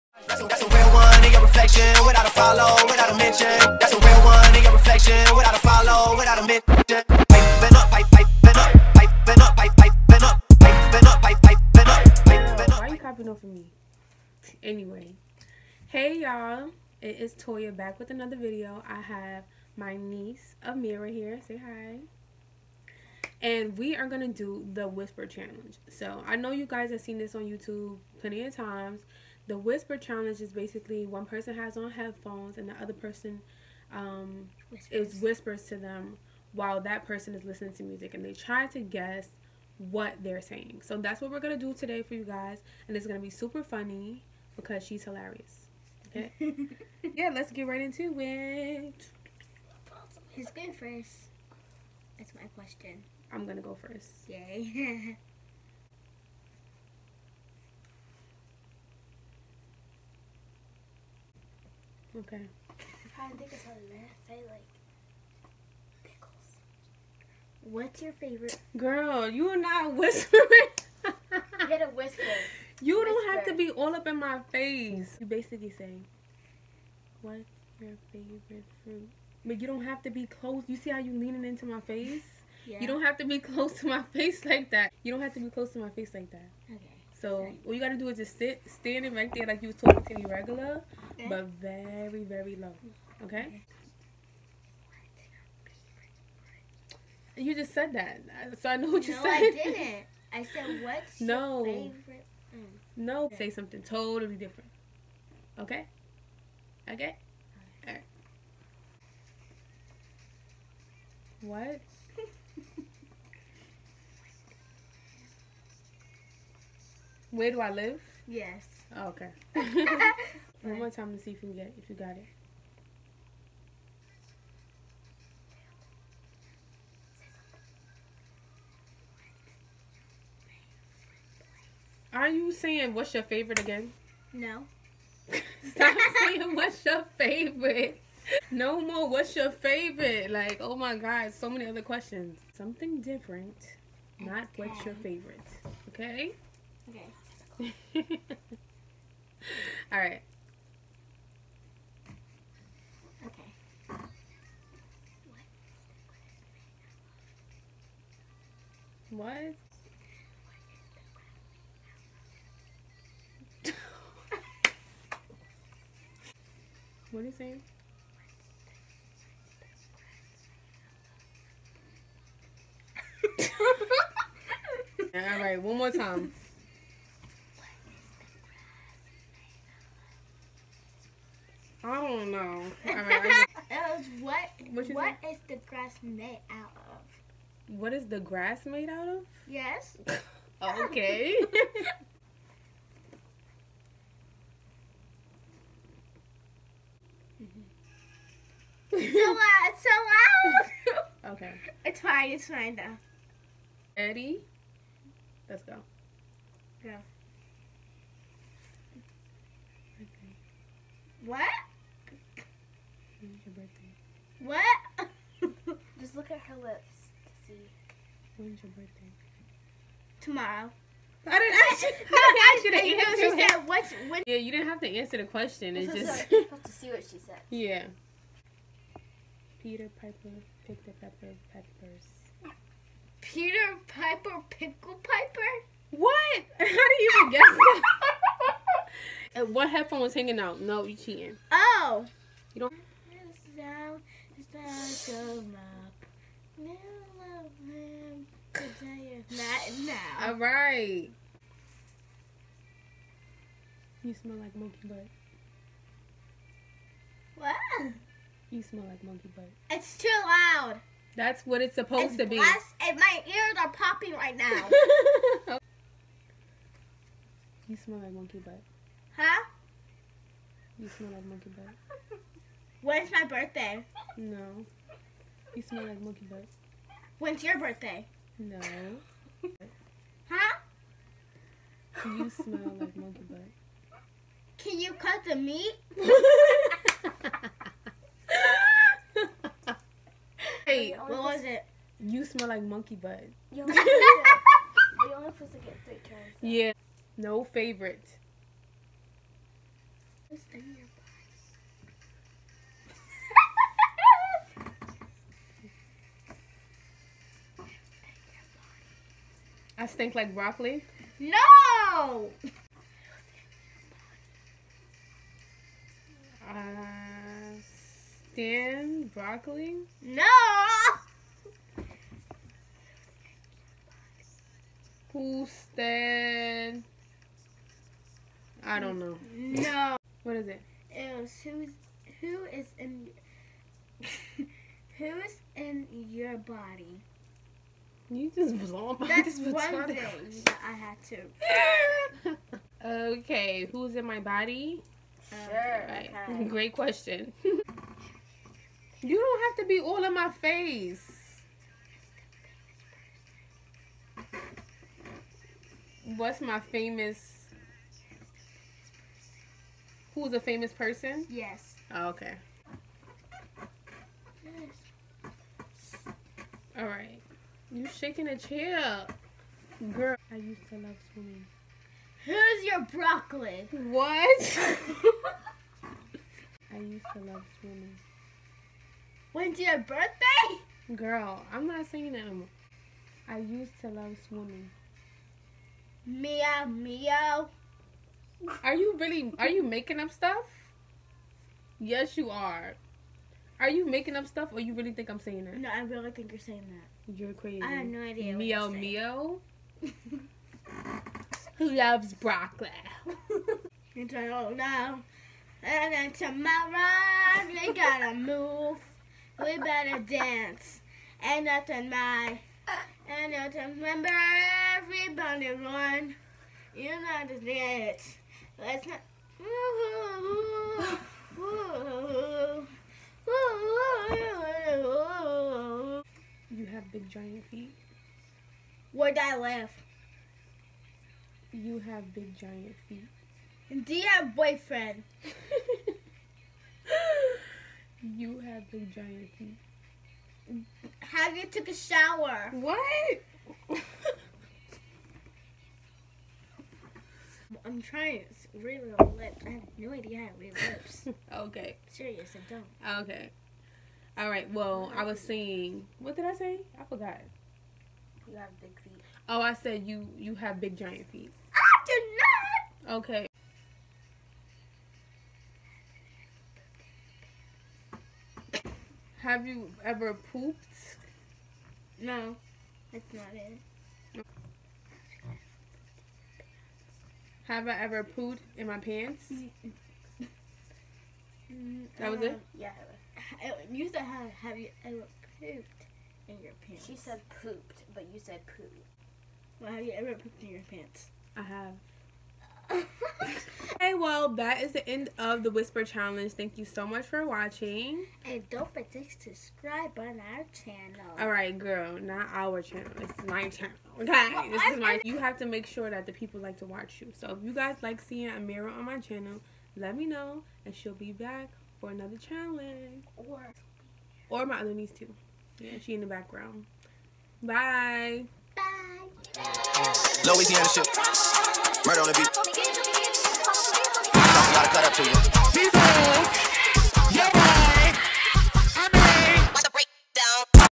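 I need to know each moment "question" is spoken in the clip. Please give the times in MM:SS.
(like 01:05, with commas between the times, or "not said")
00:52, 02:21, 03:45, 05:46.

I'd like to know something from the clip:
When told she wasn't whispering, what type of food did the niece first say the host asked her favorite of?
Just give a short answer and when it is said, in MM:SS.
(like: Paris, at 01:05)
fruit, at 01:18.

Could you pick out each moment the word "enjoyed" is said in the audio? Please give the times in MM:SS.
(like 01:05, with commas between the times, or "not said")
not said.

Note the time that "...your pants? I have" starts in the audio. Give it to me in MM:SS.
08:10.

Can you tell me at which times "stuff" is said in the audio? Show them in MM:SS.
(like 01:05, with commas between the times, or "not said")
06:30, 06:34.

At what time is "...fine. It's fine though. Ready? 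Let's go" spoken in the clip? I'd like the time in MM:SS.
03:22.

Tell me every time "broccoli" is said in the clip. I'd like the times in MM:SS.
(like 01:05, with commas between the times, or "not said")
05:10, 05:19, 06:12, 06:42.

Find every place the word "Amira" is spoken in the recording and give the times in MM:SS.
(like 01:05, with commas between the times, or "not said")
00:20, 08:28.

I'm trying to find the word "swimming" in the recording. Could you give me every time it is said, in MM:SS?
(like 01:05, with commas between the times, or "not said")
06:11, 06:17, 06:24.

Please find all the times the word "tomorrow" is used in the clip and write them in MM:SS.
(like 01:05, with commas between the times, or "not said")
03:40, 06:46.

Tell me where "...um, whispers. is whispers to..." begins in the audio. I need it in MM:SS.
00:33.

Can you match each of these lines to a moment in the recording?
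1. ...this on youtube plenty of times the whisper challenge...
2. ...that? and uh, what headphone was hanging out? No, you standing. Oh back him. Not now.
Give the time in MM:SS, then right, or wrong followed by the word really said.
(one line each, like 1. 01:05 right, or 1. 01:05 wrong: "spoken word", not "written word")
1. 00:27 right
2. 03:57 wrong: "cheating", not "standing".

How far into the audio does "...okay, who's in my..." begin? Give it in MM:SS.
05:43.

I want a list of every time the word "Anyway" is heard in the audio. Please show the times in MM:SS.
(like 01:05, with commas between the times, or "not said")
00:14.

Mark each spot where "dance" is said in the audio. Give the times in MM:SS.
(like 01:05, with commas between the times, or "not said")
06:49, 06:57.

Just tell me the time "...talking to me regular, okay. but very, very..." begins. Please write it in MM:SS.
01:29.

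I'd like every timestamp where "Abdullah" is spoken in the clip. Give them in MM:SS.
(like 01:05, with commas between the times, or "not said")
not said.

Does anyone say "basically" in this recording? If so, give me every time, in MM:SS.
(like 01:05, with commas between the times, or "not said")
00:30, 01:15.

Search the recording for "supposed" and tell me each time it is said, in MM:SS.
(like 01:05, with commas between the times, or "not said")
04:21, 04:55.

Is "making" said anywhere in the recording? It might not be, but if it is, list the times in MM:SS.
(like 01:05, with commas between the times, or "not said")
06:29, 06:33.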